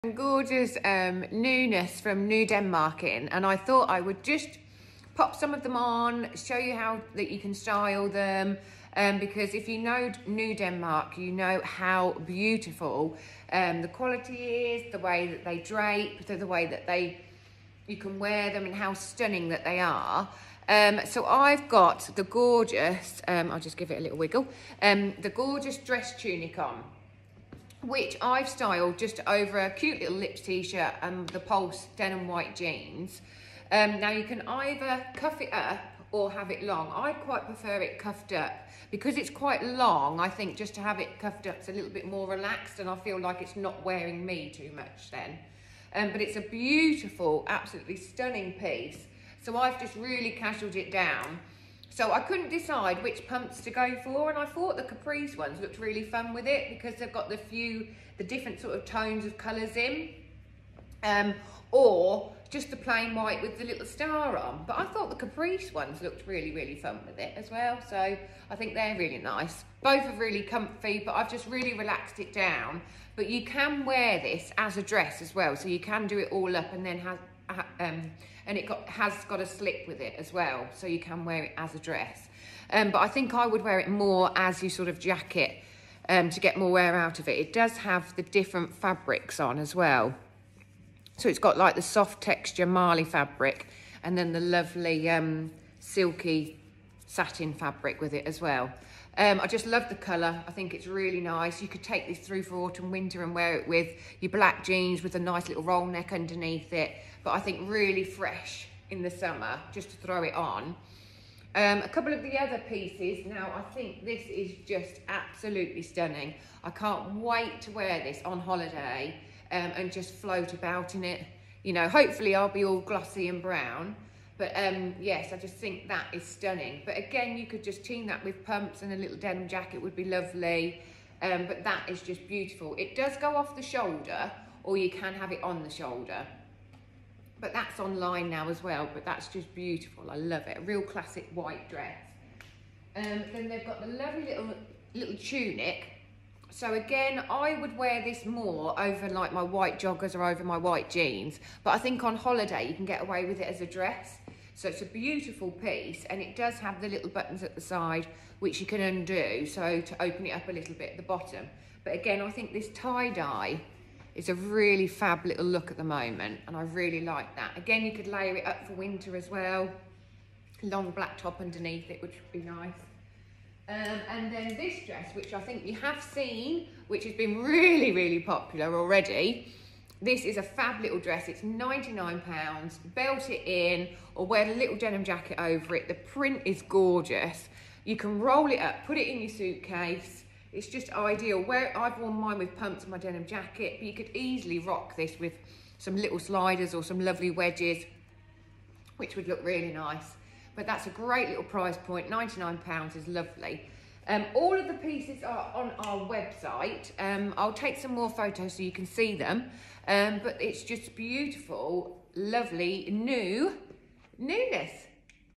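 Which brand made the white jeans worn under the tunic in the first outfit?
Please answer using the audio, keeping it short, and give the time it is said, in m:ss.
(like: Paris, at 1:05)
Pulz, at 0:31.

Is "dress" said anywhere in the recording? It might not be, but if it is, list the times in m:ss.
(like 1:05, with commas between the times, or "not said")
0:25, 1:14, 1:21, 2:21, 2:33, 2:54, 3:00.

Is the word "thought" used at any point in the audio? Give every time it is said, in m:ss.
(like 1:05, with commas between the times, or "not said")
0:03, 0:54, 1:04.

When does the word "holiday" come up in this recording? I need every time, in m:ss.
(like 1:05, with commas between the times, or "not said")
1:58, 2:32.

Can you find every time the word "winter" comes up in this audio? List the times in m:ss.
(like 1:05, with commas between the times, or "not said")
1:42, 2:48.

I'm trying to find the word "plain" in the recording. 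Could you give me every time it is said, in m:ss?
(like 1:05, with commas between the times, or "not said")
1:02.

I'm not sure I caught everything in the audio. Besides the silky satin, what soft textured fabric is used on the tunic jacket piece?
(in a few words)
marley.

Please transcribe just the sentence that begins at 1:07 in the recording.
So I think they're really nice.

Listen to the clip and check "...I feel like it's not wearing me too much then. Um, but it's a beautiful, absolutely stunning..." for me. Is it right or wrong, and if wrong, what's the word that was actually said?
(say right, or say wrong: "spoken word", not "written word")
right.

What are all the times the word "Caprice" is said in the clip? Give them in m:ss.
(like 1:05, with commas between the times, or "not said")
0:54, 1:05.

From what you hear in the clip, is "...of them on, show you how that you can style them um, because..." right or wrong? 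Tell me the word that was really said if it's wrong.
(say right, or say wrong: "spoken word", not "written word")
right.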